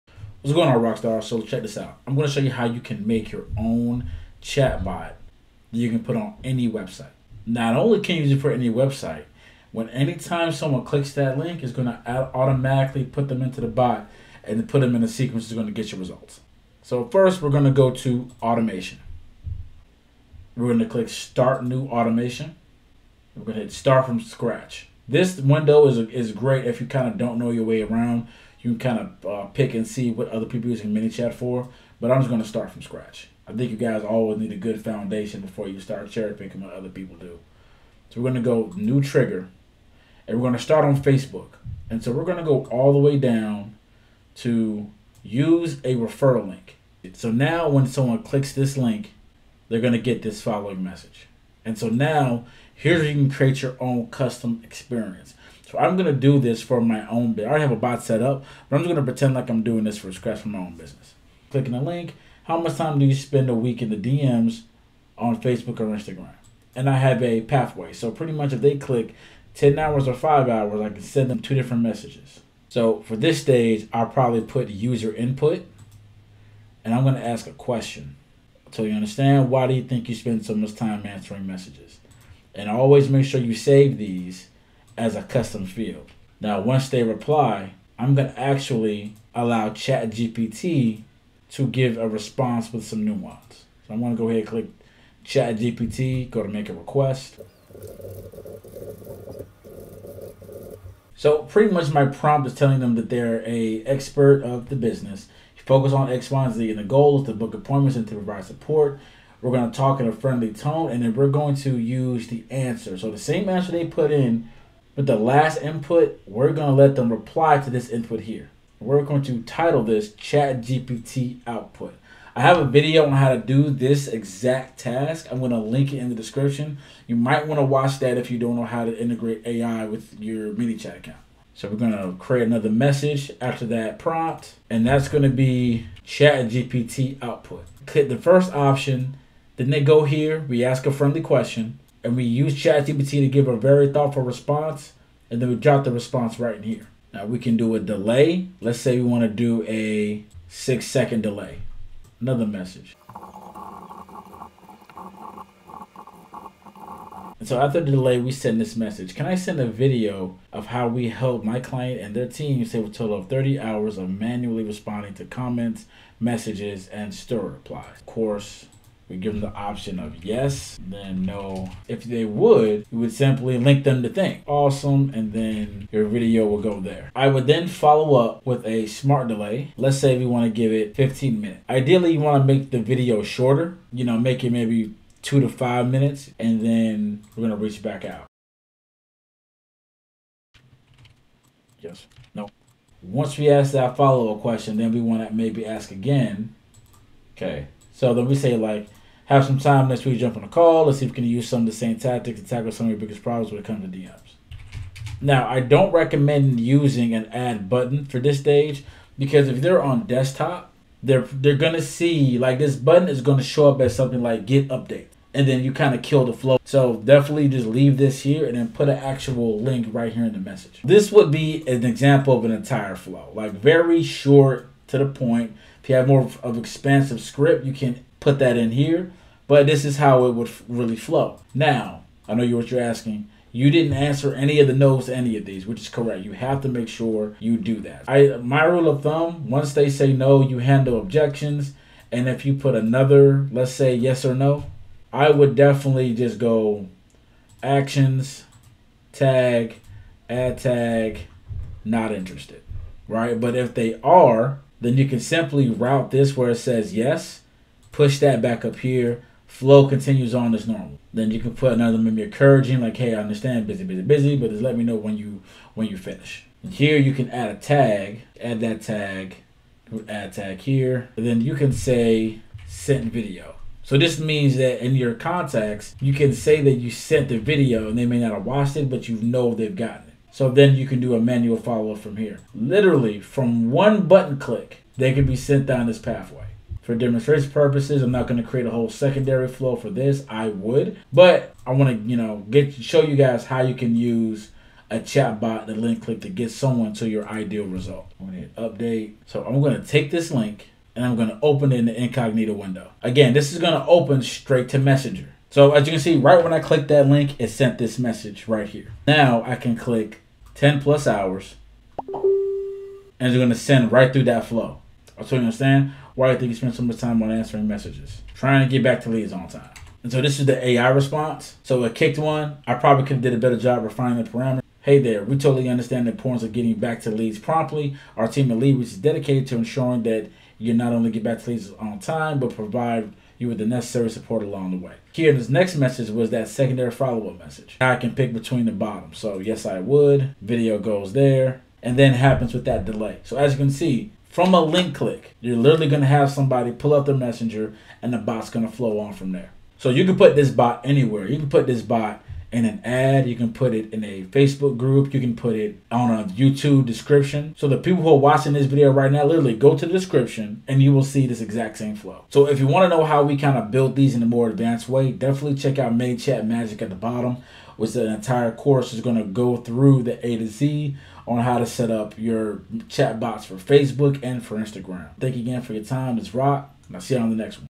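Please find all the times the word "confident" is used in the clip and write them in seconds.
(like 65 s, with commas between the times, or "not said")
not said.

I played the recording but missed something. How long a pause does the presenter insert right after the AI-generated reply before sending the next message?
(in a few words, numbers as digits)
6 seconds.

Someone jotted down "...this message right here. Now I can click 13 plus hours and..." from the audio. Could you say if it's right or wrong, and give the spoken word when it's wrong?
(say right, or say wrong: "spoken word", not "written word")
wrong: "10", not "13".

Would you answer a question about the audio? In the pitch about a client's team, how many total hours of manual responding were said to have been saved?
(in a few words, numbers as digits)
30 hours.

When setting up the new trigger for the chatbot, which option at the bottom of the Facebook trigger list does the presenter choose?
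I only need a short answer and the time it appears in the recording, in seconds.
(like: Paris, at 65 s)
Referral link, at 45 s.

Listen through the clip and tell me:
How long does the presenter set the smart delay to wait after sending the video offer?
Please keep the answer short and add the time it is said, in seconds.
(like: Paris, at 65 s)
15 minutes, at 180 s.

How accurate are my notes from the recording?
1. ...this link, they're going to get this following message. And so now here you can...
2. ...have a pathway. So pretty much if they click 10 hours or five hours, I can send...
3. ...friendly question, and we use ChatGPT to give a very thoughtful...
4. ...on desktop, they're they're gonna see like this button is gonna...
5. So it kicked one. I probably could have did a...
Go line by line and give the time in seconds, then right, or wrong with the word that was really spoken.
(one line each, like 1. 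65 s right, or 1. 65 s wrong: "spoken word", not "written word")
1. 48 s right
2. 66 s right
3. 140 s right
4. 209 s right
5. 321 s right.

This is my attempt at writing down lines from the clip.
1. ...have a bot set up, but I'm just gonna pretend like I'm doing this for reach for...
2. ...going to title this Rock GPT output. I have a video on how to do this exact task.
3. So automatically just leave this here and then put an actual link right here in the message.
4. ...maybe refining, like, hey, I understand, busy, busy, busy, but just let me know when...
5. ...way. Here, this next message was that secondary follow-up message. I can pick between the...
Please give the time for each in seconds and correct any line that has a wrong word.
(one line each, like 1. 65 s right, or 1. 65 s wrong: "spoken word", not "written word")
1. 57 s wrong: "scratch", not "reach"
2. 119 s wrong: "Chat", not "Rock"
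3. 216 s wrong: "definitely", not "automatically"
4. 261 s wrong: "encouraging", not "refining"
5. 334 s right.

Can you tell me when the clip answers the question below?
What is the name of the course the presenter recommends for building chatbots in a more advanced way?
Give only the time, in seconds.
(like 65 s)
366 s.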